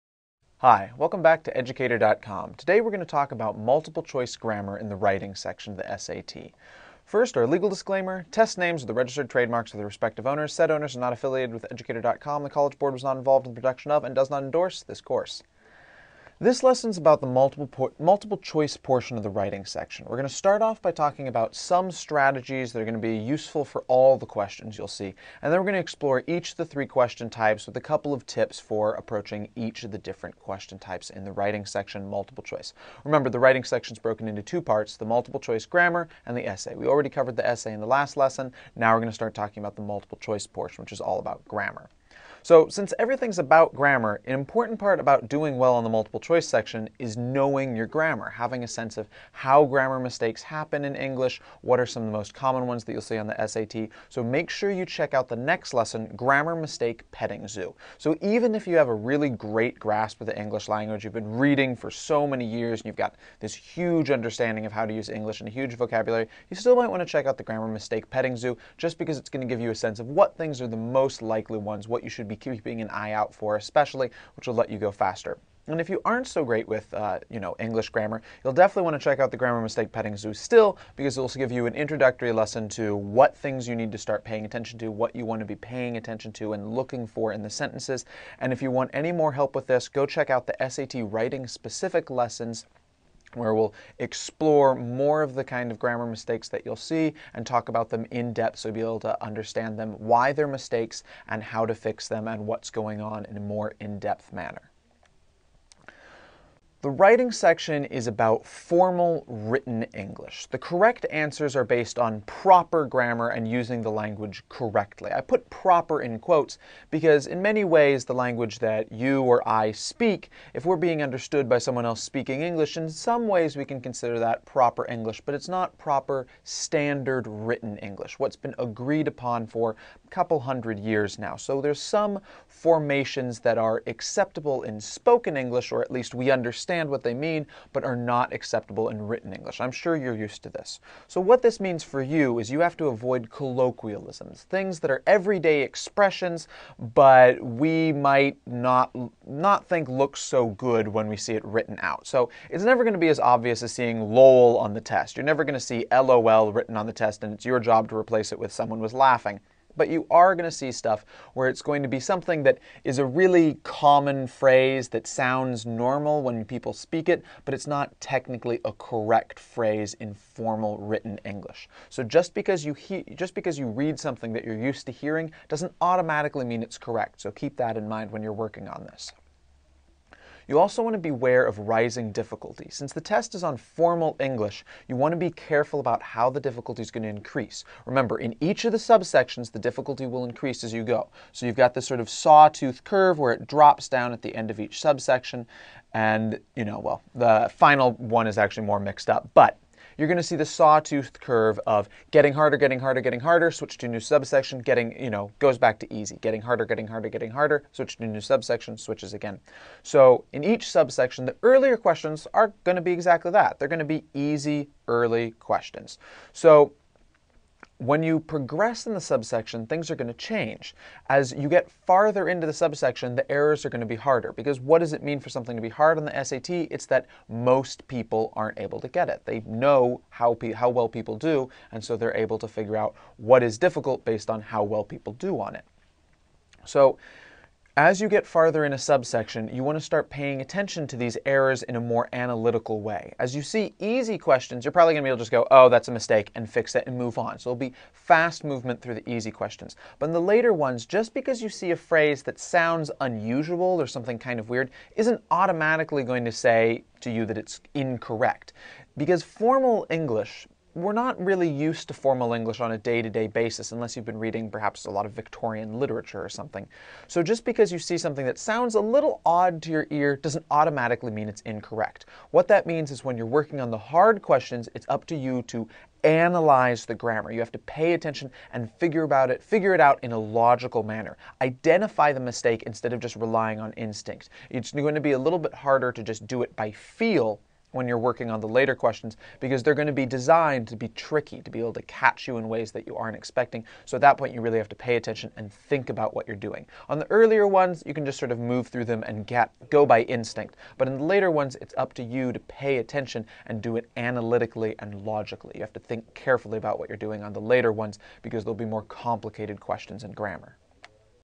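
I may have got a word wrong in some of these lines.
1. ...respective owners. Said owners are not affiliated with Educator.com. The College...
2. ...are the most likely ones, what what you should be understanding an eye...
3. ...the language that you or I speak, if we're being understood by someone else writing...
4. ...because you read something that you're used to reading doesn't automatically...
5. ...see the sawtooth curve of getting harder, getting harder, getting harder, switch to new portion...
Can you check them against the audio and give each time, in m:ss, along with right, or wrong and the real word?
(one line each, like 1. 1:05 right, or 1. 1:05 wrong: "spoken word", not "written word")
1. 0:09 right
2. 1:10 wrong: "keeping", not "understanding"
3. 1:58 wrong: "speaking", not "writing"
4. 2:53 wrong: "hearing", not "reading"
5. 3:20 wrong: "subsection", not "portion".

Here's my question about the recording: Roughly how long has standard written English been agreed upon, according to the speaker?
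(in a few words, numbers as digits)
a couple hundred years.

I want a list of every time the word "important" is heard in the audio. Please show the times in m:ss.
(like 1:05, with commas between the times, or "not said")
0:44.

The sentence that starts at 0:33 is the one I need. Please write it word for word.
Remember, the writing section's broken into two parts, the multiple choice grammar and the essay.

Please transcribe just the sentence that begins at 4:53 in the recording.
So at that point, you really have to pay attention and think about what you're doing.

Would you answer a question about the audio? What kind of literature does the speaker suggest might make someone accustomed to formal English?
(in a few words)
Victorian literature.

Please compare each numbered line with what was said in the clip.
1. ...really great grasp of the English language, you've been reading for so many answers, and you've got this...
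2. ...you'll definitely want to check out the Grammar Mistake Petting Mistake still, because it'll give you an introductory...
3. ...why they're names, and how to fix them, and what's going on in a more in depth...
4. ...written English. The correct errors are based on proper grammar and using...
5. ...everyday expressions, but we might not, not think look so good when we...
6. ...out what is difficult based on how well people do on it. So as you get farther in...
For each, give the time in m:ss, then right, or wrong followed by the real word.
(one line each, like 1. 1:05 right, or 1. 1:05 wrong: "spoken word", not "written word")
1. 0:58 wrong: "years", not "answers"
2. 1:18 wrong: "Zoo", not "Mistake"
3. 1:39 wrong: "mistakes", not "names"
4. 1:49 wrong: "answers", not "errors"
5. 2:25 right
6. 3:52 right.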